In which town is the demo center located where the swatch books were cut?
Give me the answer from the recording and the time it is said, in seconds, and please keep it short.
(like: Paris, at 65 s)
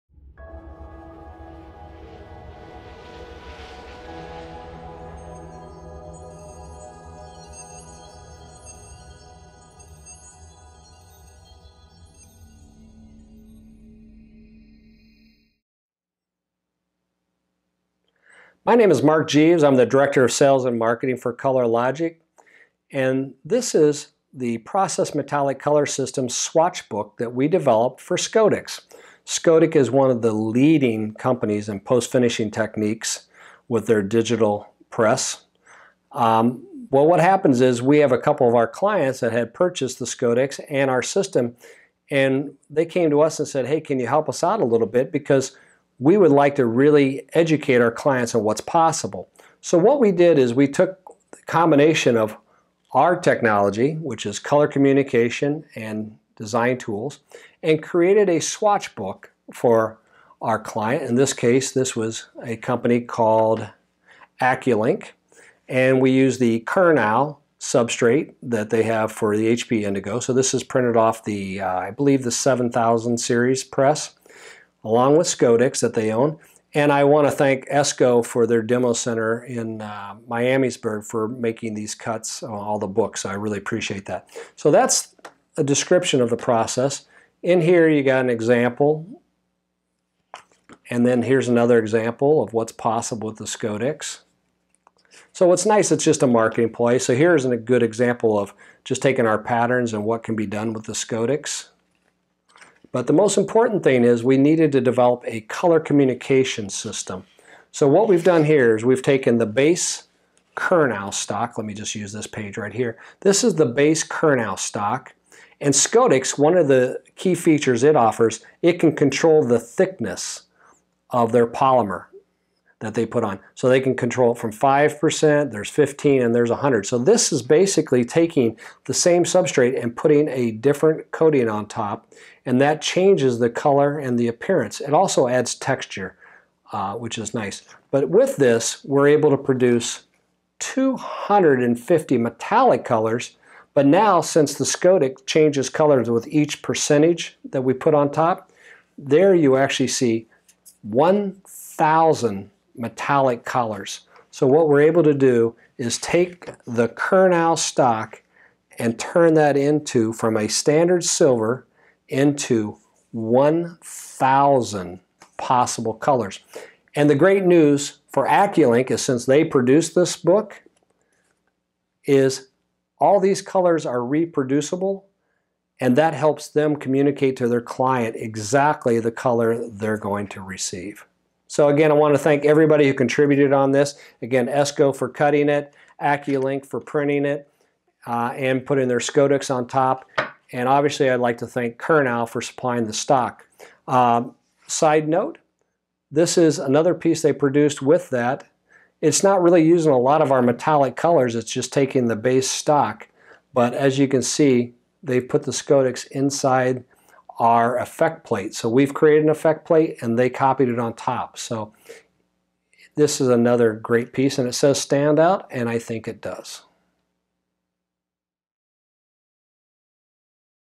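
Miamisburg, at 80 s.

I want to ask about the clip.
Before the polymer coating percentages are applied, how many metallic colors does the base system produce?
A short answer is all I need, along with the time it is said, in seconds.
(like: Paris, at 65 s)
250, at 140 s.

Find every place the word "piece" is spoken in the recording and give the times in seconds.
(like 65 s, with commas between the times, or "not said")
196 s, 214 s.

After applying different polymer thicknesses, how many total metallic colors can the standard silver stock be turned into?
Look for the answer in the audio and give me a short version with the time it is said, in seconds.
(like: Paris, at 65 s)
1,000, at 163 s.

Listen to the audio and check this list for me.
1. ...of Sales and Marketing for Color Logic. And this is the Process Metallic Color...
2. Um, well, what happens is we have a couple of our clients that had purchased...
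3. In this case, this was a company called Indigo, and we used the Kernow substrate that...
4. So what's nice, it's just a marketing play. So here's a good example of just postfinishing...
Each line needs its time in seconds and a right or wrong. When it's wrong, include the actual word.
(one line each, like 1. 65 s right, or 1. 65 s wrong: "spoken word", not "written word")
1. 20 s right
2. 36 s right
3. 61 s wrong: "AccuLink", not "Indigo"
4. 95 s wrong: "taking", not "postfinishing".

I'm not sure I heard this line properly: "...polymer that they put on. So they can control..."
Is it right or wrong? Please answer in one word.
right.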